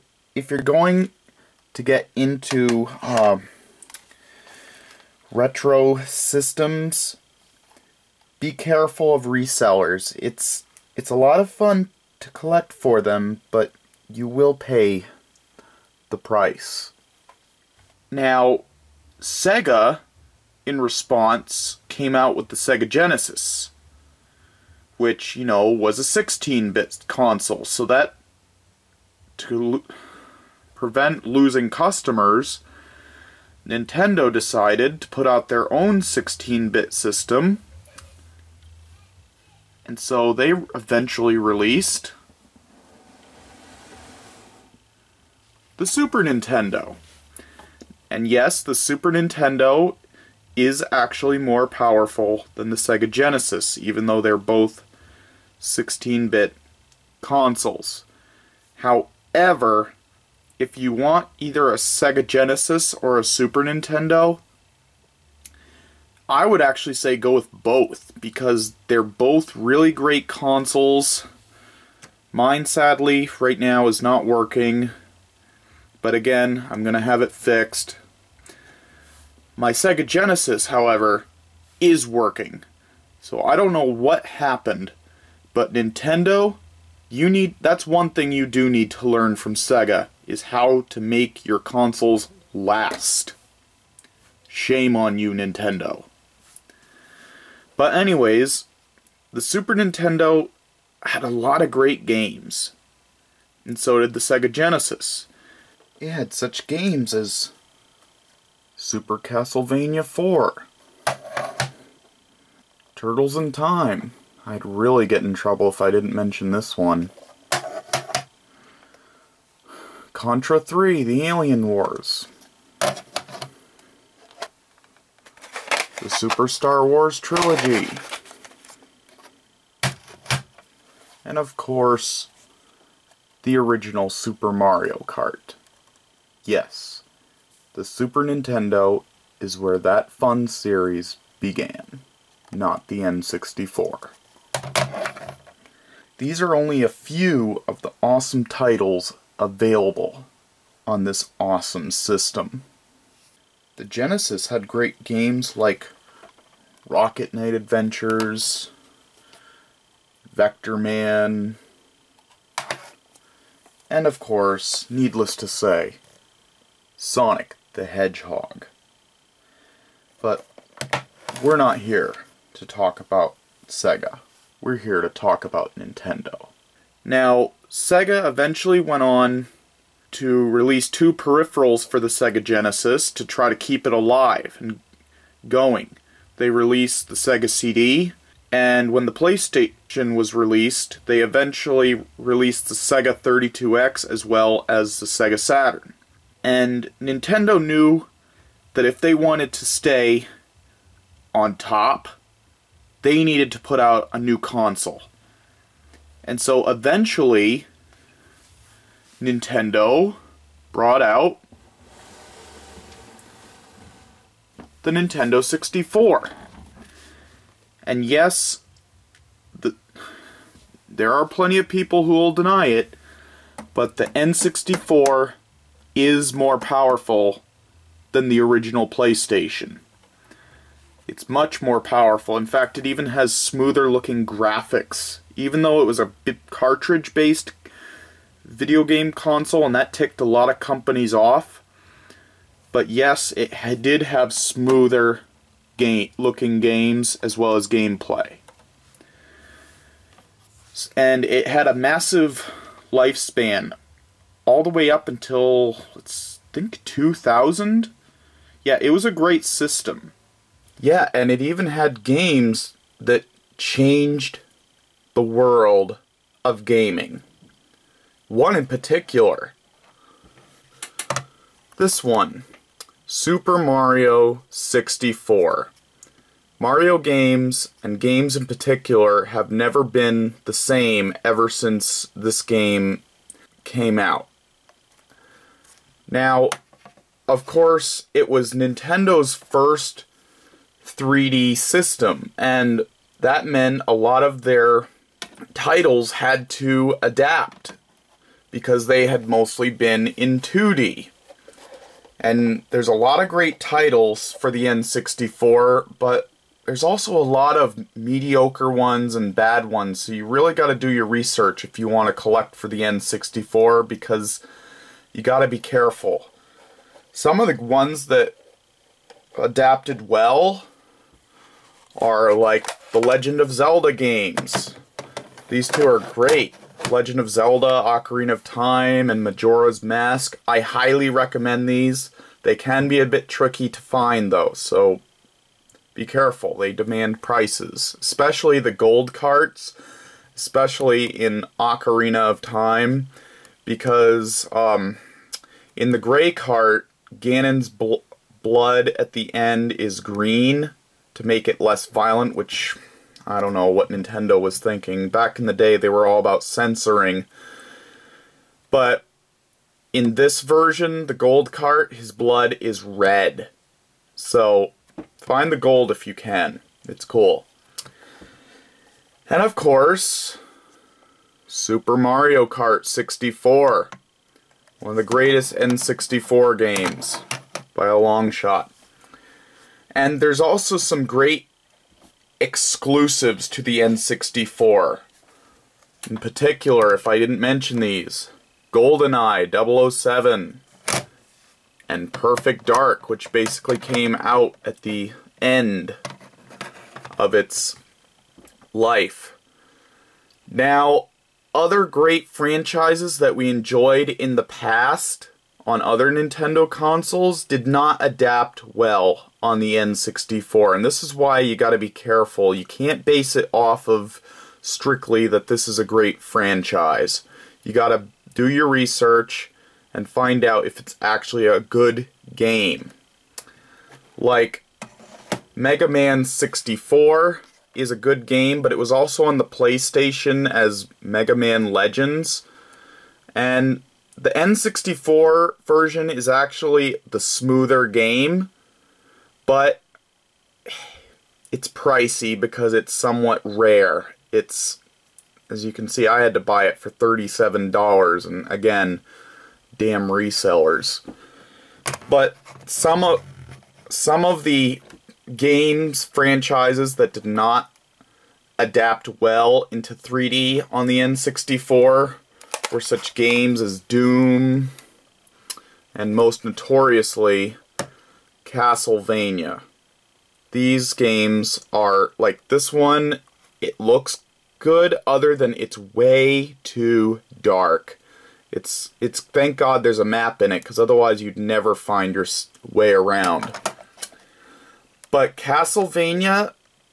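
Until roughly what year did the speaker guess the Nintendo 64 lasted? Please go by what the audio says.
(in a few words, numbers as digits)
2000.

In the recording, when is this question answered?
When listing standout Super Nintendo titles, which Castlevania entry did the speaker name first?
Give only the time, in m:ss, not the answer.
1:48.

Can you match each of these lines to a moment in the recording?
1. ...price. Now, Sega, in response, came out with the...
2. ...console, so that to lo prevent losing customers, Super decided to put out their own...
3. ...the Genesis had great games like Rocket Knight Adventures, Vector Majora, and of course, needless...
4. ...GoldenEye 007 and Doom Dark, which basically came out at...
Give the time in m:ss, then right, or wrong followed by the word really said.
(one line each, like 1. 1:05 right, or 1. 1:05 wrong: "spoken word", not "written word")
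1. 0:16 right
2. 0:27 wrong: "Nintendo", not "Super"
3. 2:33 wrong: "Man", not "Majora"
4. 6:28 wrong: "Perfect", not "Doom".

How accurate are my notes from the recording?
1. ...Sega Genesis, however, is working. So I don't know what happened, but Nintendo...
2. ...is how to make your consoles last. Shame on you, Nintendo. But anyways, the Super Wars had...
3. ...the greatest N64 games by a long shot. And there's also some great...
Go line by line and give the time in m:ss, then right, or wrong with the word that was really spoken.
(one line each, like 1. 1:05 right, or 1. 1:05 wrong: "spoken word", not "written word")
1. 1:19 right
2. 1:30 wrong: "Nintendo", not "Wars"
3. 6:14 right.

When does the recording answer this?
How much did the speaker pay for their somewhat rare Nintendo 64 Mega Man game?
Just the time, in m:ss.
7:26.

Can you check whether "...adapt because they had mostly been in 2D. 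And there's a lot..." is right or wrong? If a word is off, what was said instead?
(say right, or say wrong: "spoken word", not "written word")
right.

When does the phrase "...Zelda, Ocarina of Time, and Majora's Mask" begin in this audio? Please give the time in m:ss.
5:27.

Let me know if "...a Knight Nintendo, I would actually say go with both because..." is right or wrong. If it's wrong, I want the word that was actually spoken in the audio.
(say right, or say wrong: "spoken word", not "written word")
wrong: "Super", not "Knight".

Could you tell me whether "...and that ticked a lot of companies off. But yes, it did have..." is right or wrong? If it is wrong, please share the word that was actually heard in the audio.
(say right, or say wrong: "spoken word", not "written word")
right.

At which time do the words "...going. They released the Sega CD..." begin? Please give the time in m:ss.
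3:05.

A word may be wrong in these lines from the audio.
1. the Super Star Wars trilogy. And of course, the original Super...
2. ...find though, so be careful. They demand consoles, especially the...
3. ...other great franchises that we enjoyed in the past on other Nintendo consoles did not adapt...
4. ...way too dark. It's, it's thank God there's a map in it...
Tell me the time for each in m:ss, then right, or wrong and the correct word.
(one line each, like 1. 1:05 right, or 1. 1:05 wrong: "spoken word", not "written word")
1. 2:06 right
2. 5:33 wrong: "prices", not "consoles"
3. 6:41 right
4. 7:55 right.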